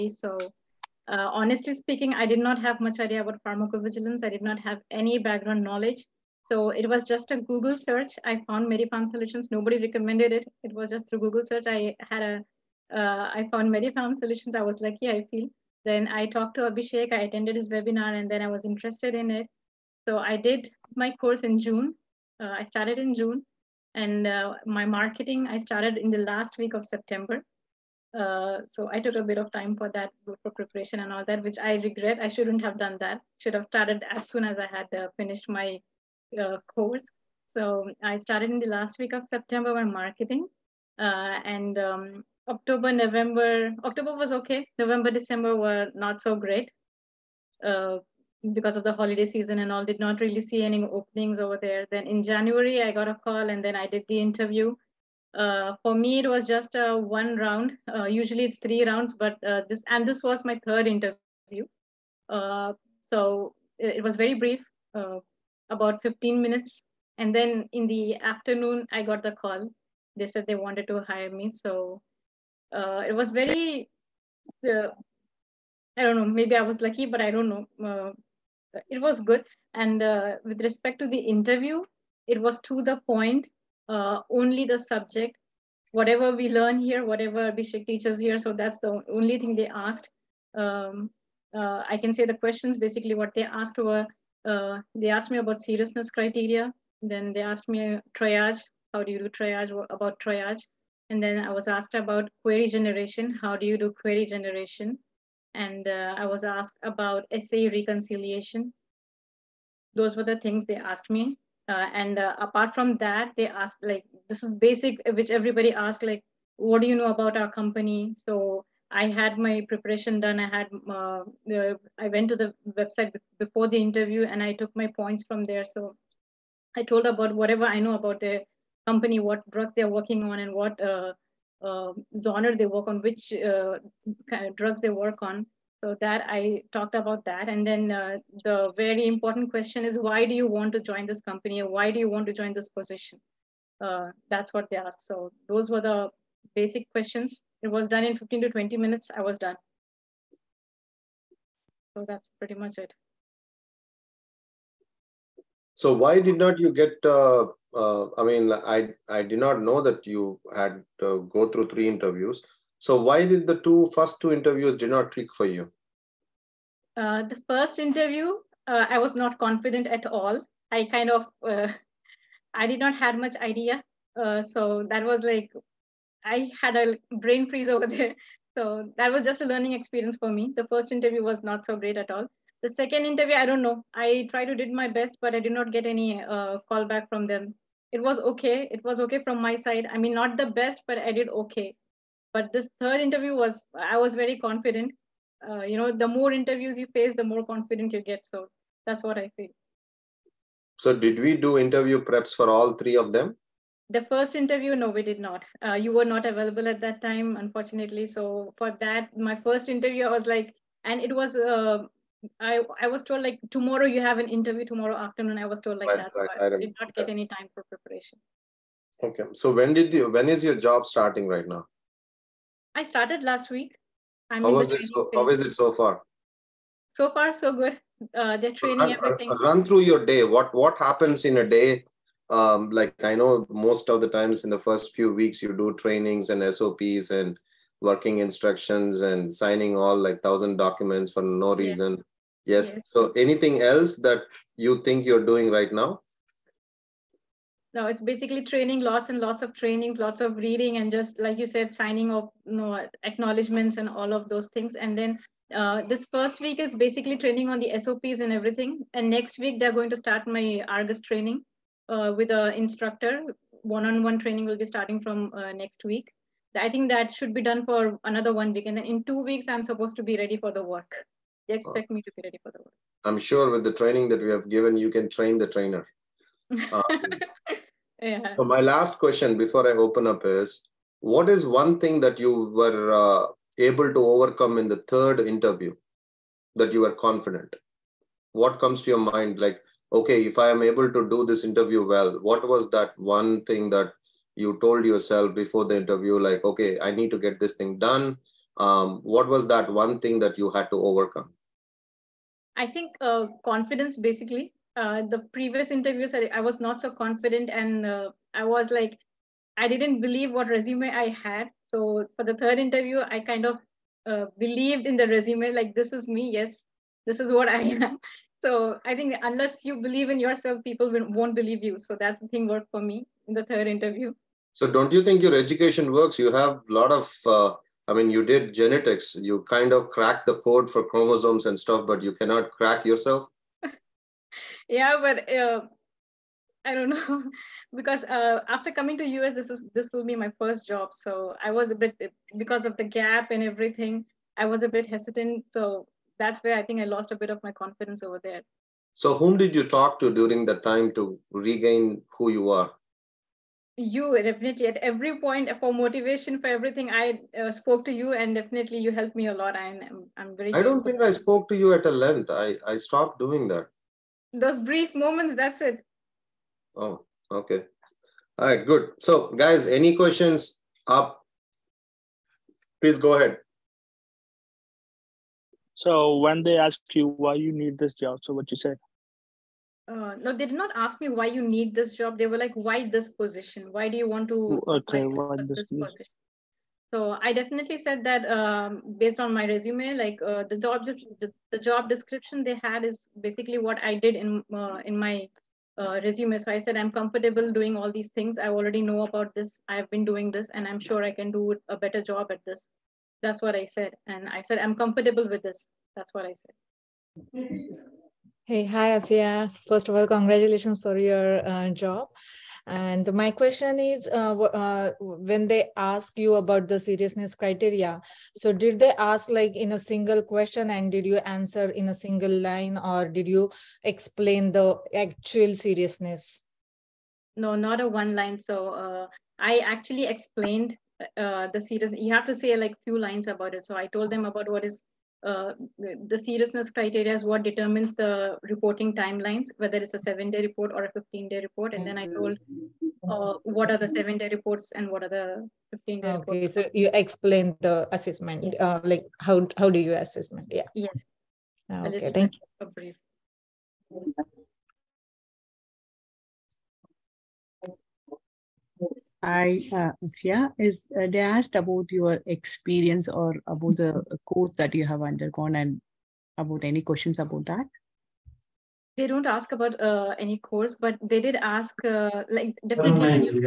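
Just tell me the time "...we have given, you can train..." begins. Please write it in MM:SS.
04:34.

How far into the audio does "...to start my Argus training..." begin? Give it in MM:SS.
04:19.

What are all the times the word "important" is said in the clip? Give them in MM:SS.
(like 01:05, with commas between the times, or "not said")
02:19.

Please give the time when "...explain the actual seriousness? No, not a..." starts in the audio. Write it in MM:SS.
07:03.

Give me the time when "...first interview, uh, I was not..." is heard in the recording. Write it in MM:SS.
02:47.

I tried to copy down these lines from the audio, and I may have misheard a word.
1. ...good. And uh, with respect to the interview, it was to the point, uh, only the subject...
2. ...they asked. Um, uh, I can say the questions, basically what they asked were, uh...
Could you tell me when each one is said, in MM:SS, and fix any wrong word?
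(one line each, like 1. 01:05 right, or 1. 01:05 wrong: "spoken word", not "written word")
1. 01:19 right
2. 01:29 right.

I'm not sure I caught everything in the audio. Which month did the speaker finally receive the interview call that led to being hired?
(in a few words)
January.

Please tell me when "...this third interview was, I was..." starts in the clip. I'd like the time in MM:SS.
03:12.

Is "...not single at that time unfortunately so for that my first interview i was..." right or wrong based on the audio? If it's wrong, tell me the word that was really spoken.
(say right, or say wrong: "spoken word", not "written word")
wrong: "available", not "single".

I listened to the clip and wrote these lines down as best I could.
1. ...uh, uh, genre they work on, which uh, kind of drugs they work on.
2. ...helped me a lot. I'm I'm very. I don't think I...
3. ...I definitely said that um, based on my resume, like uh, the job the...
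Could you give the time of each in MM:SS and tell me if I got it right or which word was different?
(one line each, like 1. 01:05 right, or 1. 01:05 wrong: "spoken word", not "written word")
1. 02:10 right
2. 05:58 right
3. 06:27 right.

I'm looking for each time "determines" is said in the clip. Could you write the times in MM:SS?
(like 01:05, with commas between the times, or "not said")
07:17.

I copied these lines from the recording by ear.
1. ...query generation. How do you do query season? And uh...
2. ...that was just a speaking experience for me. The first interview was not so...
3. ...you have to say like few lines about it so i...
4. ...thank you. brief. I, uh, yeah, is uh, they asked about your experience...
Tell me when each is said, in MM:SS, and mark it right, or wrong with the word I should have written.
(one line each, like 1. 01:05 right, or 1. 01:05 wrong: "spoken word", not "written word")
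1. 01:42 wrong: "generation", not "season"
2. 02:58 wrong: "learning", not "speaking"
3. 07:11 right
4. 07:32 right.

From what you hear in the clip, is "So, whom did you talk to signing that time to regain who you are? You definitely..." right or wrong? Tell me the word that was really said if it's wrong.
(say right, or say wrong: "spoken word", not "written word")
wrong: "during", not "signing".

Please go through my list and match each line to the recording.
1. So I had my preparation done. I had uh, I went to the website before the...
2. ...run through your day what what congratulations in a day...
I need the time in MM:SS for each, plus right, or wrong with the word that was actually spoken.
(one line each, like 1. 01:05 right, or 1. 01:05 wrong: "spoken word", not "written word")
1. 01:58 right
2. 03:49 wrong: "happens", not "congratulations".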